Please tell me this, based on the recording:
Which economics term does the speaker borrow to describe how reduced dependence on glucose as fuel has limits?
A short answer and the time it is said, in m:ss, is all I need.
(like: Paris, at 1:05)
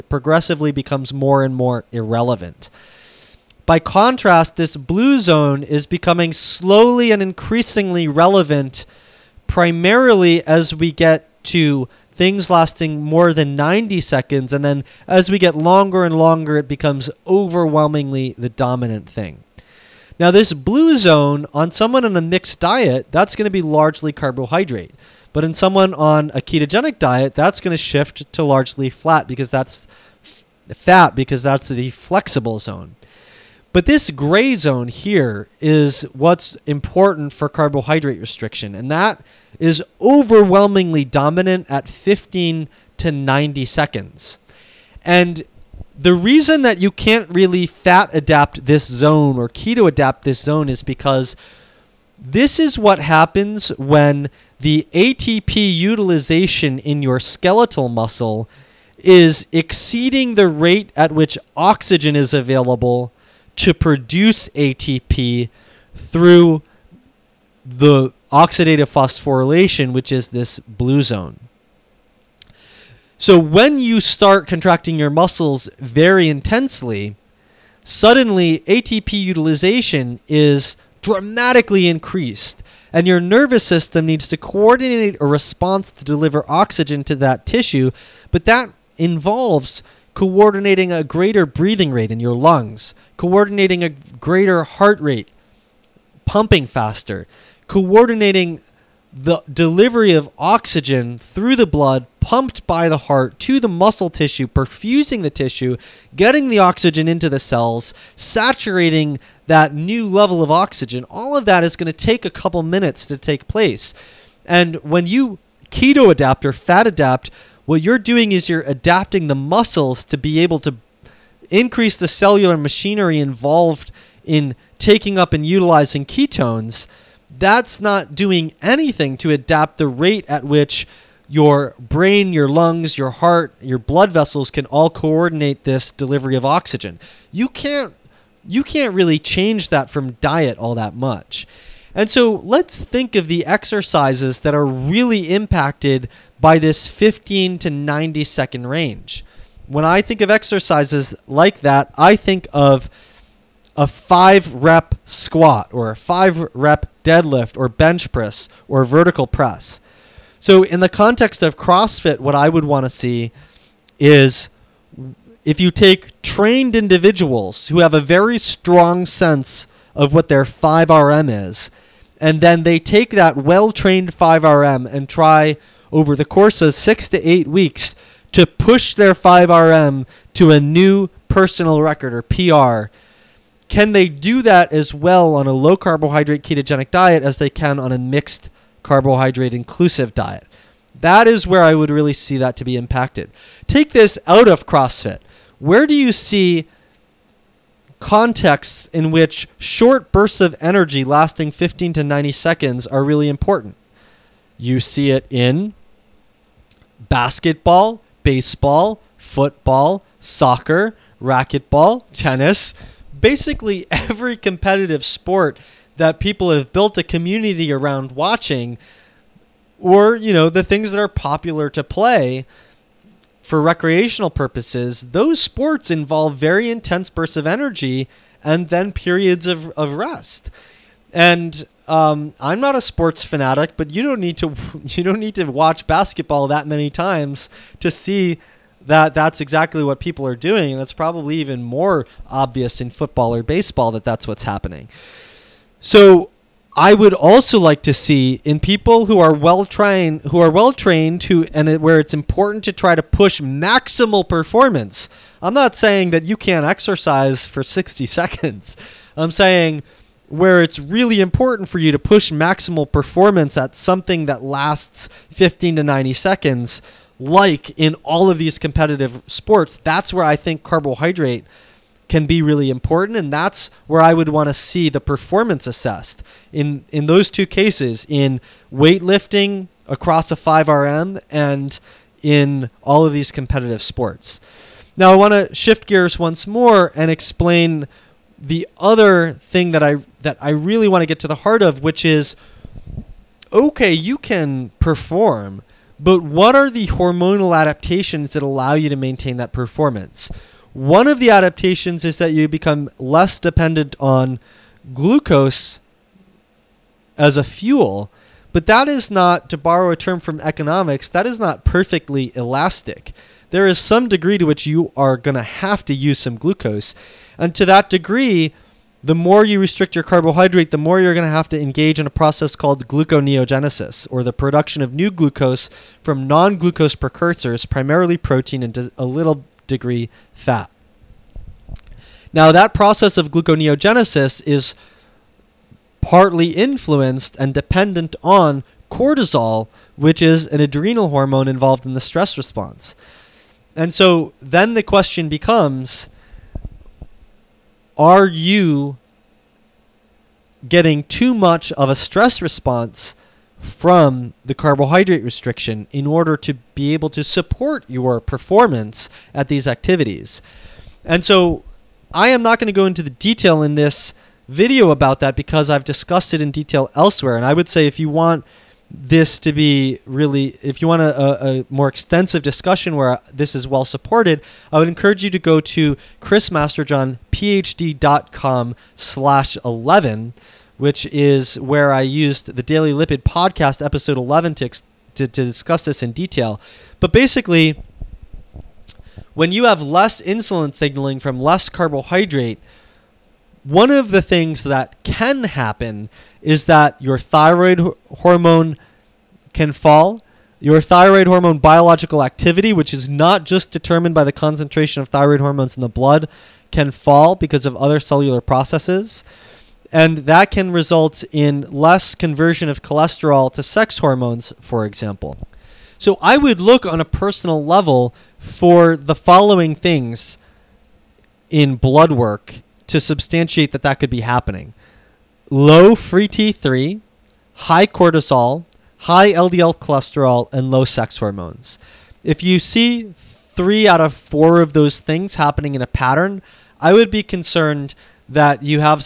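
perfectly elastic, at 5:11.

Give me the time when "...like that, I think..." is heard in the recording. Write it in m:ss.
2:31.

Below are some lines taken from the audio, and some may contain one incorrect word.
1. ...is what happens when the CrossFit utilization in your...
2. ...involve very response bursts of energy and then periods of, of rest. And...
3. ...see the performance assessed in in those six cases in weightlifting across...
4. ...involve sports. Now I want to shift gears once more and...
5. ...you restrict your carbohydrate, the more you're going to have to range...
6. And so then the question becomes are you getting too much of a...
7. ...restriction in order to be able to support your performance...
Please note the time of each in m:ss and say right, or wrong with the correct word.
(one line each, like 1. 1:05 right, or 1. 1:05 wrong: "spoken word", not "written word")
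1. 0:52 wrong: "ATP", not "CrossFit"
2. 3:45 wrong: "intense", not "response"
3. 4:34 wrong: "two", not "six"
4. 4:43 wrong: "competitive", not "involve"
5. 5:19 wrong: "engage", not "range"
6. 5:43 right
7. 5:55 right.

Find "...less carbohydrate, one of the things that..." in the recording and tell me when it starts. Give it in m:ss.
6:31.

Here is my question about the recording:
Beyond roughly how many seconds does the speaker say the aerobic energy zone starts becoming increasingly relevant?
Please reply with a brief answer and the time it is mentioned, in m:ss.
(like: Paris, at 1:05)
90 seconds, at 0:12.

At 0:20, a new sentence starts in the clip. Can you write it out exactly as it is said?
Now, this blue zone on someone on a mixed diet, that's going to be largely carbohydrate.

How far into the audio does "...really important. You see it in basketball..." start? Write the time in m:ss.
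3:23.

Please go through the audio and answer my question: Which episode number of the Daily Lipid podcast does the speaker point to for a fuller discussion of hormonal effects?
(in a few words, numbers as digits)
11.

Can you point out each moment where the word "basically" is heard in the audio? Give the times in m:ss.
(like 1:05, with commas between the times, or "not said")
3:33, 6:27.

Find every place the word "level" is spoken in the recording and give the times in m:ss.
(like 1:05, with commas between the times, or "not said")
1:50, 6:57.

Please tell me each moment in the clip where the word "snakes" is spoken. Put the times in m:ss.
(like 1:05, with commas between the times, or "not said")
not said.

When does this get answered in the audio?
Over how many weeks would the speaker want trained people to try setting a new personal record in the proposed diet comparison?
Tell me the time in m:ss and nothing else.
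2:56.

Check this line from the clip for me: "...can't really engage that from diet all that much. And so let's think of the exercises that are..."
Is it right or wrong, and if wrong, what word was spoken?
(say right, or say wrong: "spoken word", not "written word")
wrong: "change", not "engage".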